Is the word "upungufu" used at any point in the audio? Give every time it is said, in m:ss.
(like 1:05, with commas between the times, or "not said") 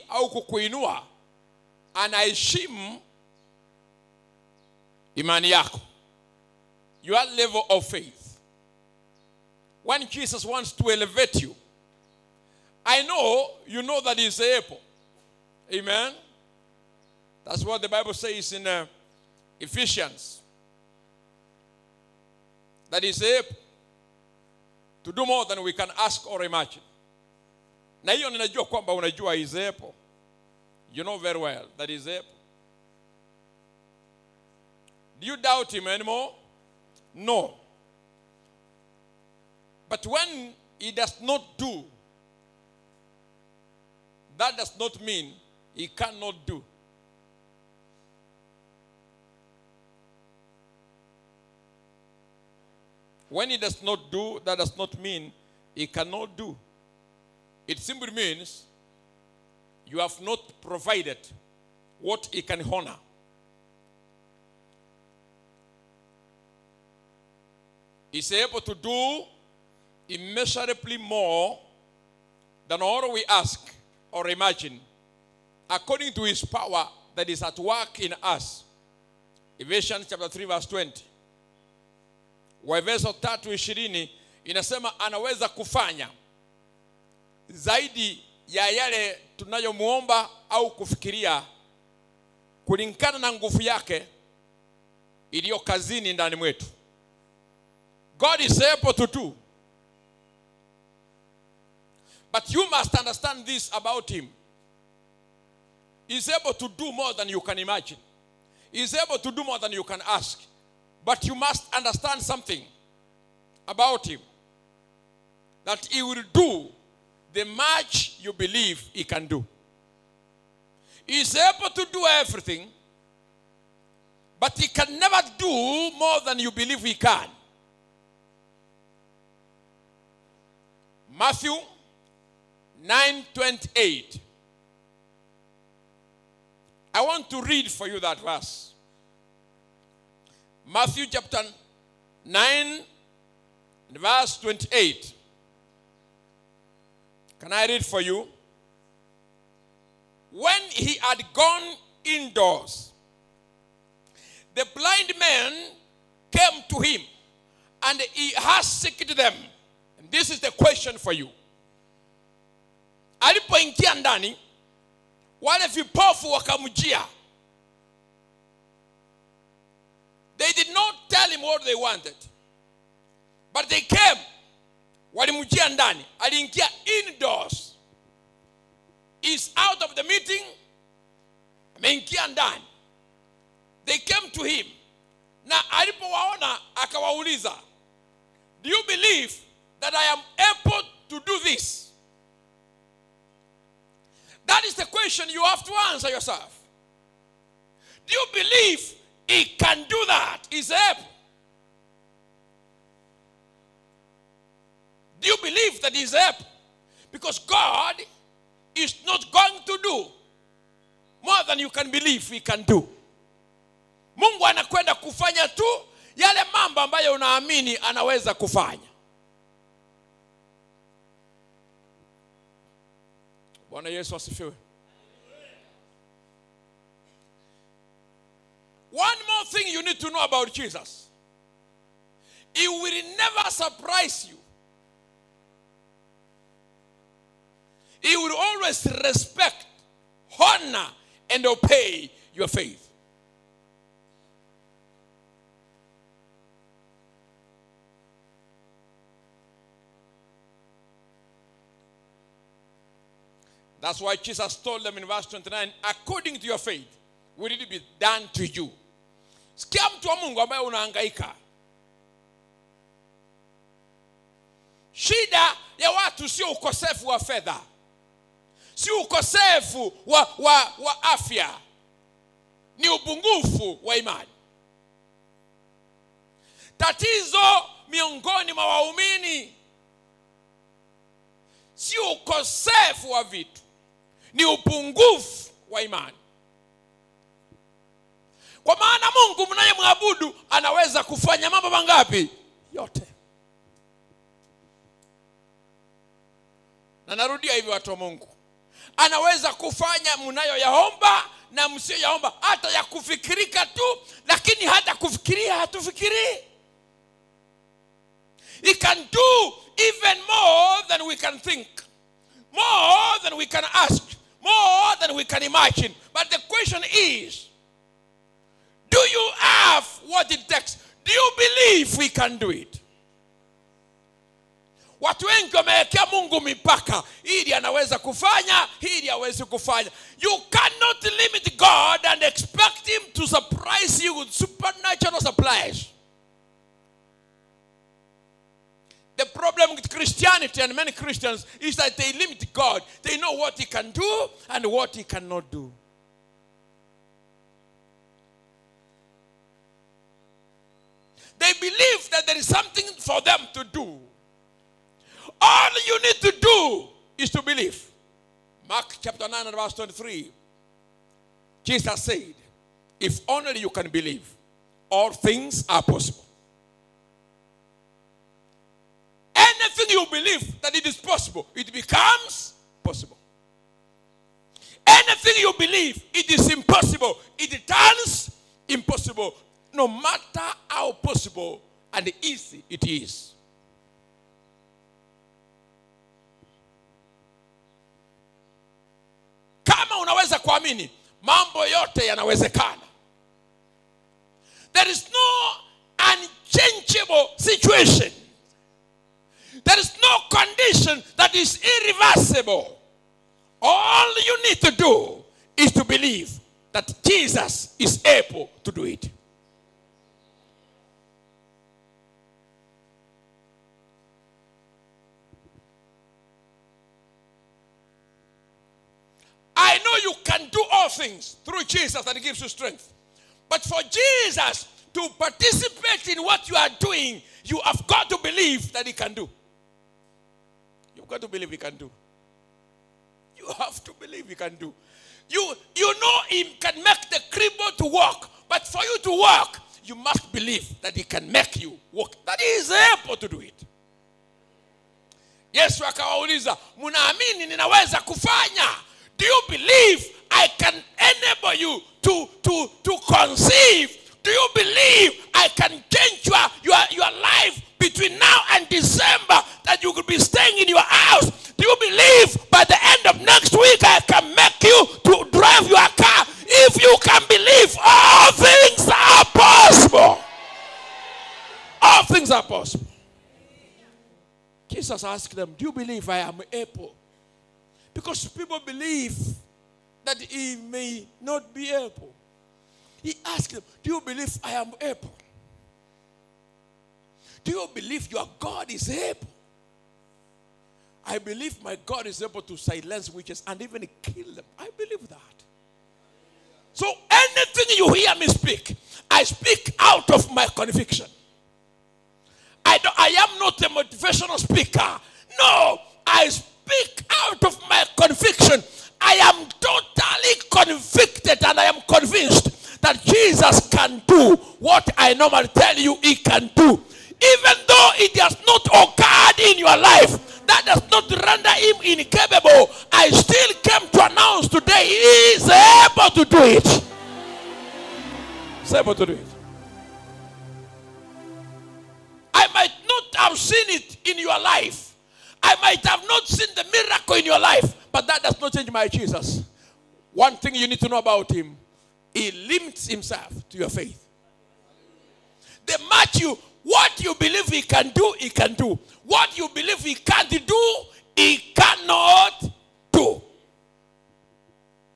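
4:32, 4:44.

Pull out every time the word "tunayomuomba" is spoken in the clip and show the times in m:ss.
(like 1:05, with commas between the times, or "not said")
1:29.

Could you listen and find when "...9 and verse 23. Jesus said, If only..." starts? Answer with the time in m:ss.
5:59.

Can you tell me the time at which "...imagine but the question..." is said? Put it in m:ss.
5:15.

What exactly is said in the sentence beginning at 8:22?
I, I am not a motivational speaker.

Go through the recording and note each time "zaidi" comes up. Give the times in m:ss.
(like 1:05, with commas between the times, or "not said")
1:27.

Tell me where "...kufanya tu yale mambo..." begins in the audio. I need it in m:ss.
3:34.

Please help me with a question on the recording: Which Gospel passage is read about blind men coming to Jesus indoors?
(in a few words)
Matthew 9:28.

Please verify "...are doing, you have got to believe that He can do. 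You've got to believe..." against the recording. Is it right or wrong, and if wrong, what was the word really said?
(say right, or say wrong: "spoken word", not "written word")
right.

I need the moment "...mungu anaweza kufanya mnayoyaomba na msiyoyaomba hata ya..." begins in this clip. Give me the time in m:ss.
4:57.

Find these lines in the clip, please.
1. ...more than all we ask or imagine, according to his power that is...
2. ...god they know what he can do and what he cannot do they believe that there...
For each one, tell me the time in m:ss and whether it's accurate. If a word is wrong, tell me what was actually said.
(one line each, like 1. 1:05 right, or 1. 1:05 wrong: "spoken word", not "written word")
1. 1:10 right
2. 5:42 right.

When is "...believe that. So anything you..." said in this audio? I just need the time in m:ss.
8:14.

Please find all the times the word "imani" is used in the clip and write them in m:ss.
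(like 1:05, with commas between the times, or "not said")
0:05, 4:33, 4:45.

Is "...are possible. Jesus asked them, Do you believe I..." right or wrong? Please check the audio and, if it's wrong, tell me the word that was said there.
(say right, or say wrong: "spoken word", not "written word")
right.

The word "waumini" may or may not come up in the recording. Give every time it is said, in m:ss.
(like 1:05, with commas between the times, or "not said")
4:38.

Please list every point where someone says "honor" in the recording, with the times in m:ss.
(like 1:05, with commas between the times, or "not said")
1:02, 4:00.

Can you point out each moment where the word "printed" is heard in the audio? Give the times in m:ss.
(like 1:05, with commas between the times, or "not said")
not said.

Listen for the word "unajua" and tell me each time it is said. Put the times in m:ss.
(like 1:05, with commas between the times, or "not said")
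0:28.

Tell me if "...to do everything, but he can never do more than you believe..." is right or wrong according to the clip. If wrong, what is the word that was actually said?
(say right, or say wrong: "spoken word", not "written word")
right.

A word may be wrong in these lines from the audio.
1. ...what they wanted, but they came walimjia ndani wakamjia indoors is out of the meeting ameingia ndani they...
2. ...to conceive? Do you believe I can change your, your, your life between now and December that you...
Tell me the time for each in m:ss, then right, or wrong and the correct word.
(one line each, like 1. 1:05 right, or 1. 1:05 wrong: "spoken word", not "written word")
1. 2:51 wrong: "aliingia", not "wakamjia"
2. 7:32 right.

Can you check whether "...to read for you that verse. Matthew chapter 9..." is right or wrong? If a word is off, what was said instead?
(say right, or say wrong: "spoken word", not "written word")
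right.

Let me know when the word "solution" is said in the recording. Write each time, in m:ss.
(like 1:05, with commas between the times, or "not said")
not said.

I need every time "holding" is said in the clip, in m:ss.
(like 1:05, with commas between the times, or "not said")
not said.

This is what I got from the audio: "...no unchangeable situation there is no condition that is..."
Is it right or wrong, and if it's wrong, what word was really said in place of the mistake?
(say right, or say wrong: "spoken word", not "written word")
right.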